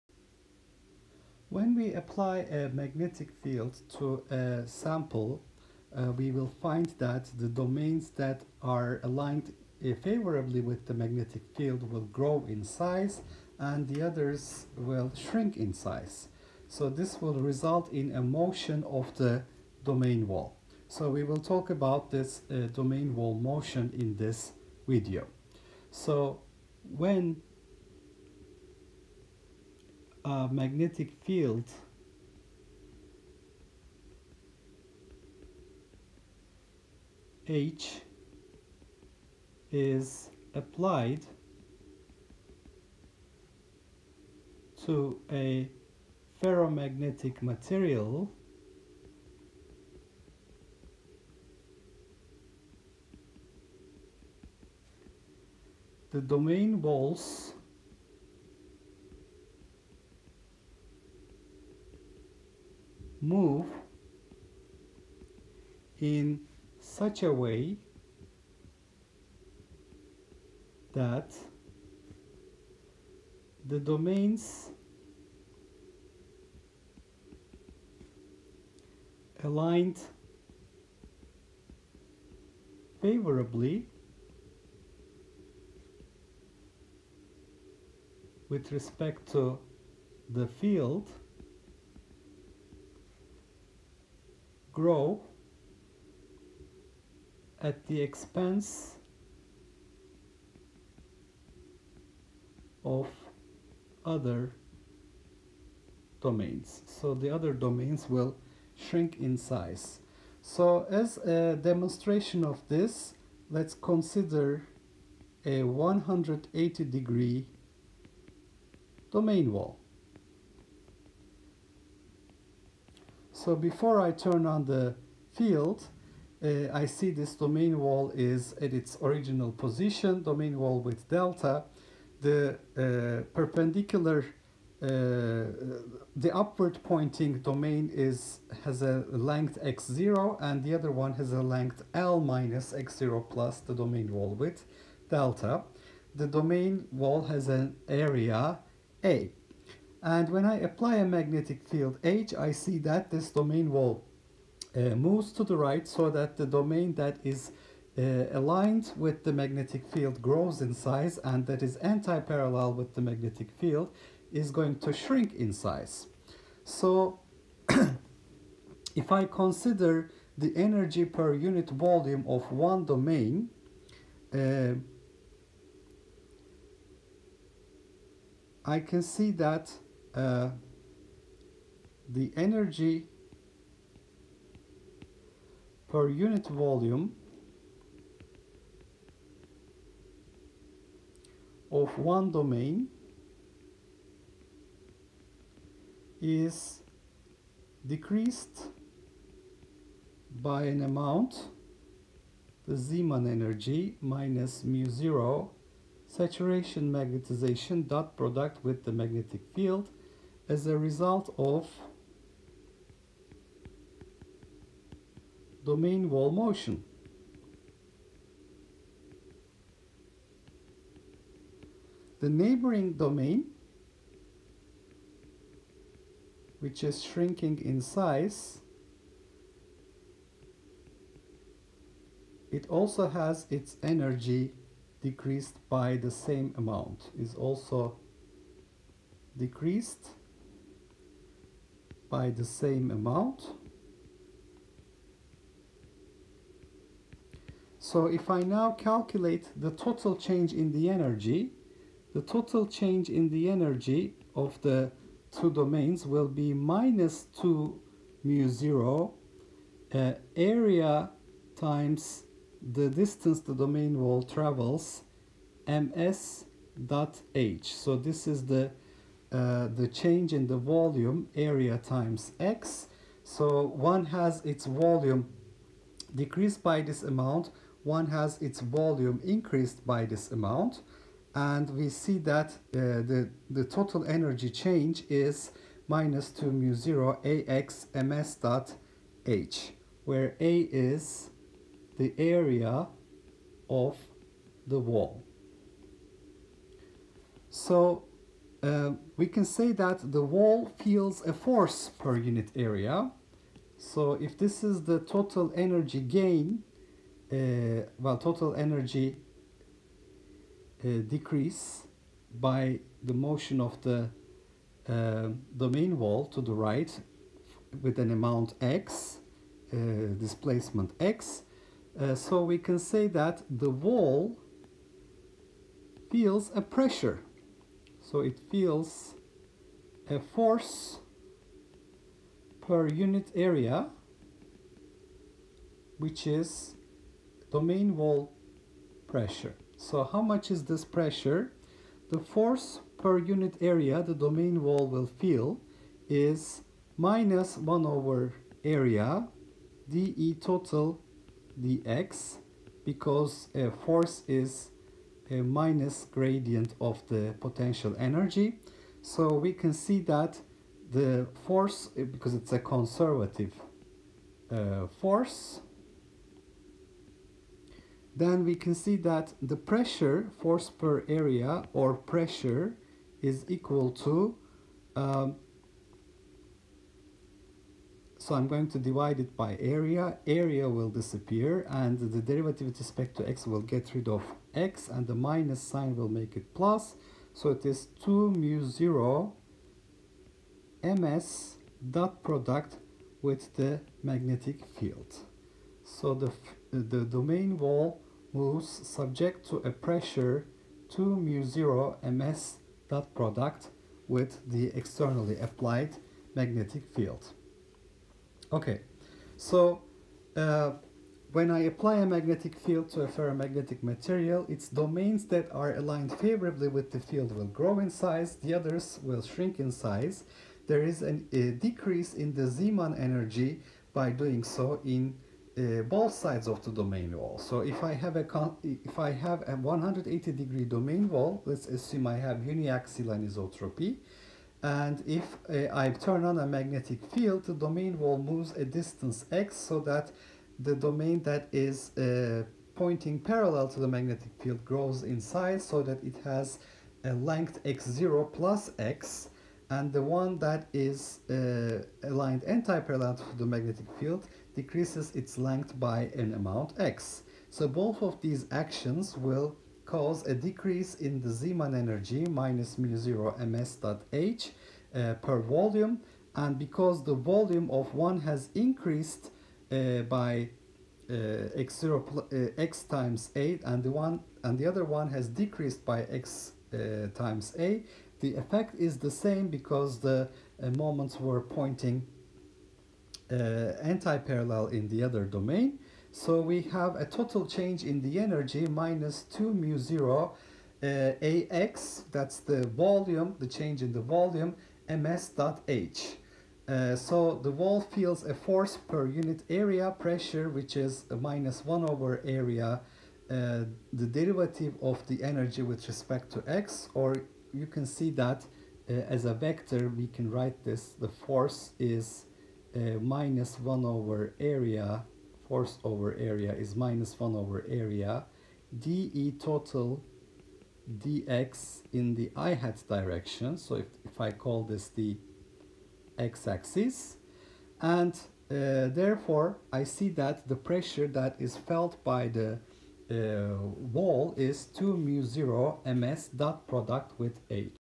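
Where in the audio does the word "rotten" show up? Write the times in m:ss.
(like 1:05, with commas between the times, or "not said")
not said.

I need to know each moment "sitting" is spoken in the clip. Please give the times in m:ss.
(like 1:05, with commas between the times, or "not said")
not said.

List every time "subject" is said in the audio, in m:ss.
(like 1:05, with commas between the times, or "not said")
6:38.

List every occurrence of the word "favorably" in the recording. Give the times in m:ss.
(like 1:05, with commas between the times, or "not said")
0:10, 1:23, 6:56.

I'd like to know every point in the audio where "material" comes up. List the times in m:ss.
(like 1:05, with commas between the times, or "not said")
0:47, 6:53.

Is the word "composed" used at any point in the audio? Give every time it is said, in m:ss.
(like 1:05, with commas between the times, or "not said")
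not said.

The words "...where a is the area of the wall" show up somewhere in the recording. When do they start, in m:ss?
4:50.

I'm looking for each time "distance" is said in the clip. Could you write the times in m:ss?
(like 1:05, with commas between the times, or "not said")
4:22, 7:18.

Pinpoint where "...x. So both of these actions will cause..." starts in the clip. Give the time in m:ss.
7:36.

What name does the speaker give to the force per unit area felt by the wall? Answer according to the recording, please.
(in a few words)
domain wall pressure.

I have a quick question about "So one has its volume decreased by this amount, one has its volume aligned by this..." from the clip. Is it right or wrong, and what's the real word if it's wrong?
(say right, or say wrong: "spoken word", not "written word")
wrong: "increased", not "aligned".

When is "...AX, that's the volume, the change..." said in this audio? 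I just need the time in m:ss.
8:11.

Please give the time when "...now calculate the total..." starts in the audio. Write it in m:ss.
4:08.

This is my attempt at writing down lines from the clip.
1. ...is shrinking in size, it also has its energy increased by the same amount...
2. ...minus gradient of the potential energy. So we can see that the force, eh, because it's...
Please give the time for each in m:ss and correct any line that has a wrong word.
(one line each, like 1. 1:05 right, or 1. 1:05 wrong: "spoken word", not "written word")
1. 3:46 wrong: "decreased", not "increased"
2. 5:55 right.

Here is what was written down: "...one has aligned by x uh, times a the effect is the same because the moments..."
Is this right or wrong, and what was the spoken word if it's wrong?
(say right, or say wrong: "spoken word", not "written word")
wrong: "decreased", not "aligned".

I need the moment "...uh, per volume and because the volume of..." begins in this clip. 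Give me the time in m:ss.
7:44.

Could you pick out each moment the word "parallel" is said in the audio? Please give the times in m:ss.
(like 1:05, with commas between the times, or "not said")
2:41, 7:23, 7:32, 8:03.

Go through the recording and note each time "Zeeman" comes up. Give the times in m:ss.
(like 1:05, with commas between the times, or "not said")
3:22, 7:02, 7:41.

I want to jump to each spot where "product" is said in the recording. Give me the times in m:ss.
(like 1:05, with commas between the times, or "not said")
3:28, 6:32, 6:43, 8:56.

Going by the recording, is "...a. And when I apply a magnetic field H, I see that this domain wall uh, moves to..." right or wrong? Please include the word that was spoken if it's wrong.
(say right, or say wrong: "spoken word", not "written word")
right.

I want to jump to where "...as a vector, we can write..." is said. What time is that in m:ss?
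8:29.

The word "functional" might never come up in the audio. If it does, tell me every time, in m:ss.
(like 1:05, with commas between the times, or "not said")
not said.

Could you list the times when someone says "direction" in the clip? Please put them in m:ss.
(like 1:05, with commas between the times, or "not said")
8:42.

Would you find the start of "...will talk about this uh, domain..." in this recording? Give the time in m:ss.
0:21.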